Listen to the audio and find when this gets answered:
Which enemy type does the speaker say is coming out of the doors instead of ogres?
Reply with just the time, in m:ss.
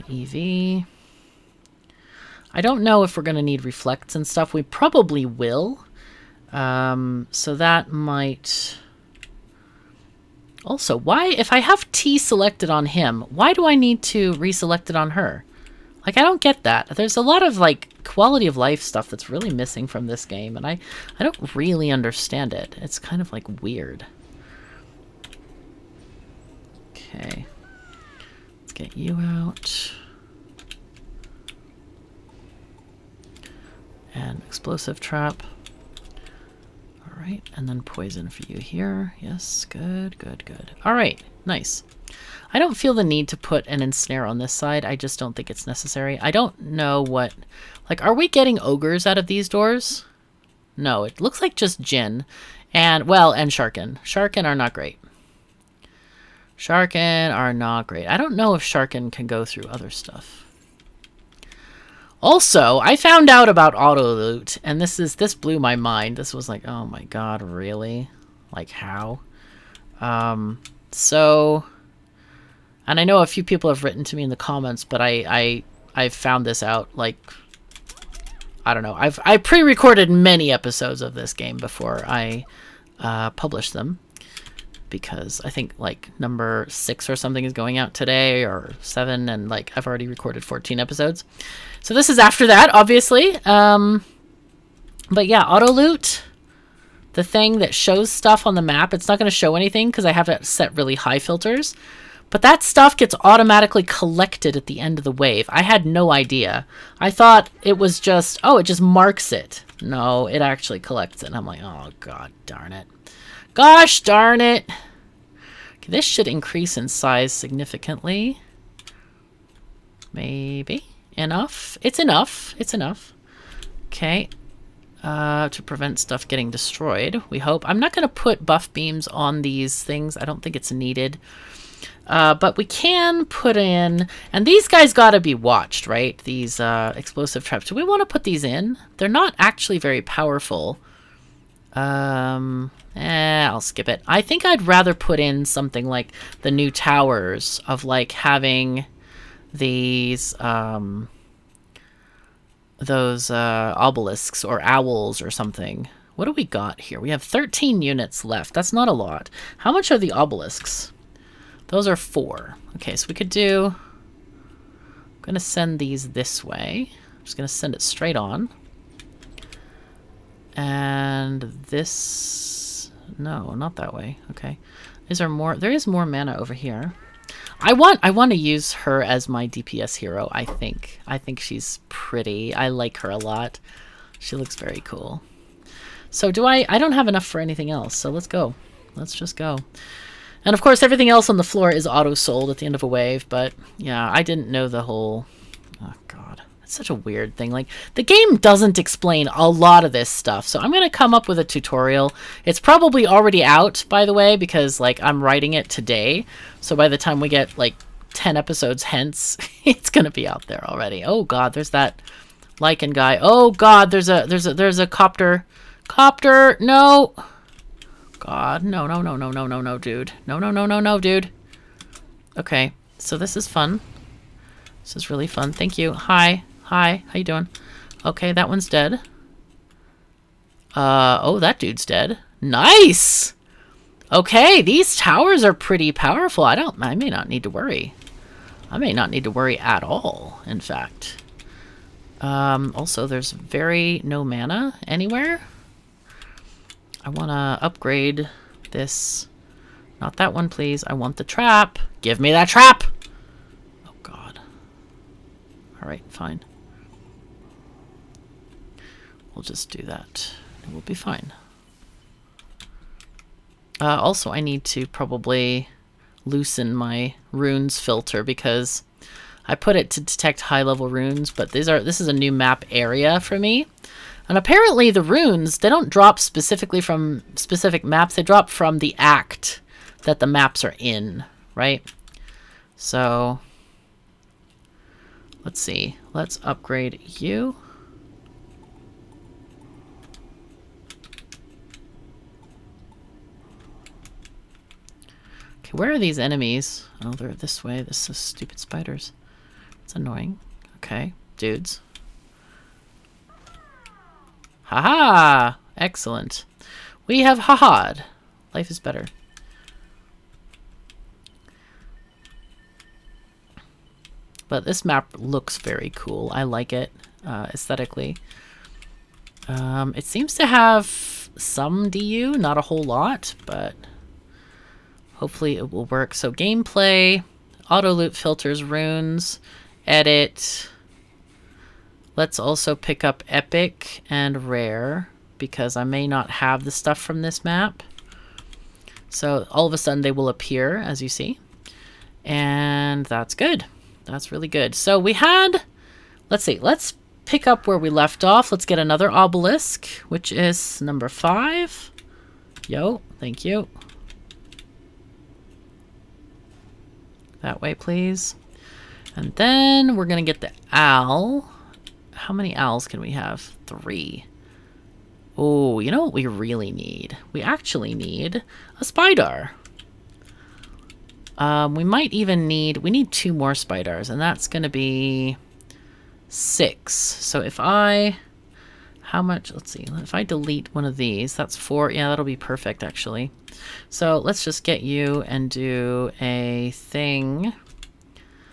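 0:51.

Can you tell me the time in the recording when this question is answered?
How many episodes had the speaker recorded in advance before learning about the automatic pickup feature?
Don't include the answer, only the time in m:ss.
1:30.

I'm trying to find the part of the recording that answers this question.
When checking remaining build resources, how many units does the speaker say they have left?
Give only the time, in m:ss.
2:37.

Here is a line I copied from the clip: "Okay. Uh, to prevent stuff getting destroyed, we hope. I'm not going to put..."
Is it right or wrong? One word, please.
right.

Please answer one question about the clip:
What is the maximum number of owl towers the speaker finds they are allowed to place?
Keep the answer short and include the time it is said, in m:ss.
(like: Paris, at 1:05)
3, at 6:03.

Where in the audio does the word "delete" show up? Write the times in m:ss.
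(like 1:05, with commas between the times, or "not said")
6:20.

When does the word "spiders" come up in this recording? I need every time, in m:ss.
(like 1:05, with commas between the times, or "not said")
4:58, 6:08, 6:13.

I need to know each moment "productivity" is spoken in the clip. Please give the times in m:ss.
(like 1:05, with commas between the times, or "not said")
not said.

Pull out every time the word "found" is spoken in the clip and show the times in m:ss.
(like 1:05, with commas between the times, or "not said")
1:02, 1:16.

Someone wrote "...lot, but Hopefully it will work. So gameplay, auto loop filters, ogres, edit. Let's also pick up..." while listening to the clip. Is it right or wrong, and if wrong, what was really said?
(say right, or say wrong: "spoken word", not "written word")
wrong: "runes", not "ogres".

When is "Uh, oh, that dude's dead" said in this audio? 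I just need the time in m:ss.
3:50.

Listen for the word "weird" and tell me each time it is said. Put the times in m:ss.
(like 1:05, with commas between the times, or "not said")
0:23, 3:16.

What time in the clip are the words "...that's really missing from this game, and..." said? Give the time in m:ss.
0:19.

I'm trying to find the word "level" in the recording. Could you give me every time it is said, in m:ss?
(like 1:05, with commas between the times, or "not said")
4:30.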